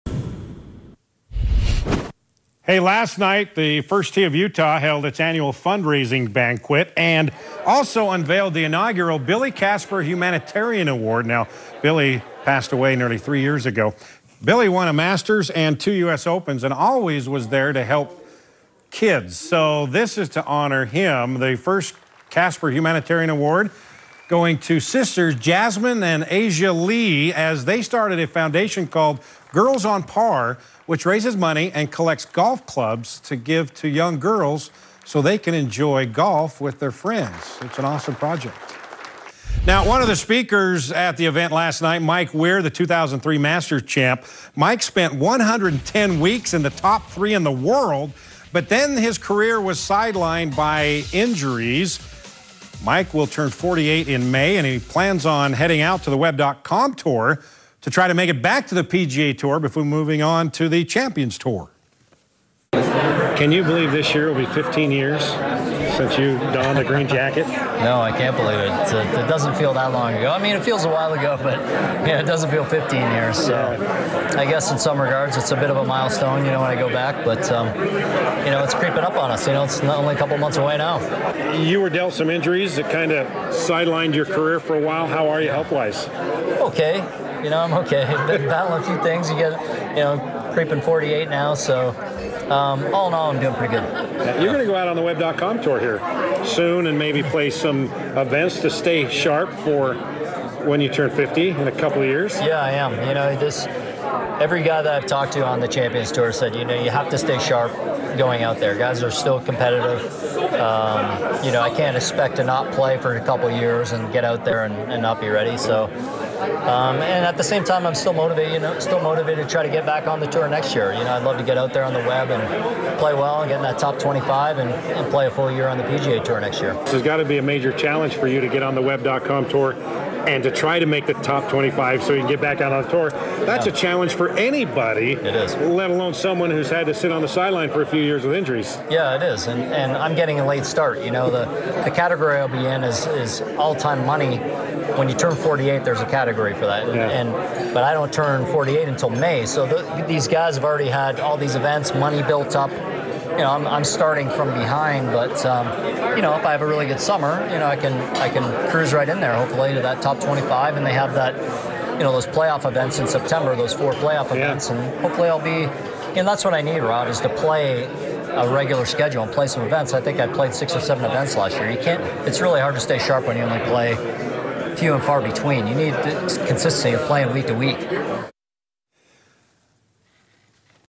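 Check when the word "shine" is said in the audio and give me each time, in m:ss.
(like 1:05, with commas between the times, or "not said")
not said.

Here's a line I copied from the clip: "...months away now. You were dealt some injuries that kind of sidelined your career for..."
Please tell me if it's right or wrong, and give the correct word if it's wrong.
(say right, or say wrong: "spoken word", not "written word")
right.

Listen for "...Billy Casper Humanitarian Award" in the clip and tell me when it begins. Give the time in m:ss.
0:09.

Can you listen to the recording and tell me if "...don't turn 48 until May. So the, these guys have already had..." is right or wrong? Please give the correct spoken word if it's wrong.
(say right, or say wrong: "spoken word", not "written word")
right.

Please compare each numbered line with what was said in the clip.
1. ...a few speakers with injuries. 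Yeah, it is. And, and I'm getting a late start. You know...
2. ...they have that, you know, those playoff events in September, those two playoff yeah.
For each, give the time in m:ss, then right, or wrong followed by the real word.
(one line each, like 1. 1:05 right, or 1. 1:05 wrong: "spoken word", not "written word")
1. 2:17 wrong: "years", not "speakers"
2. 2:40 wrong: "four", not "two".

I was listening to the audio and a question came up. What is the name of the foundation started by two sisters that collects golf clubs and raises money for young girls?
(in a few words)
Girls on Par.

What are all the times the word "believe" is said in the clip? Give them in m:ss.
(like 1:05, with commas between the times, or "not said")
1:03, 1:08.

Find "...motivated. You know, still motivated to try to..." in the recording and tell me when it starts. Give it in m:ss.
1:58.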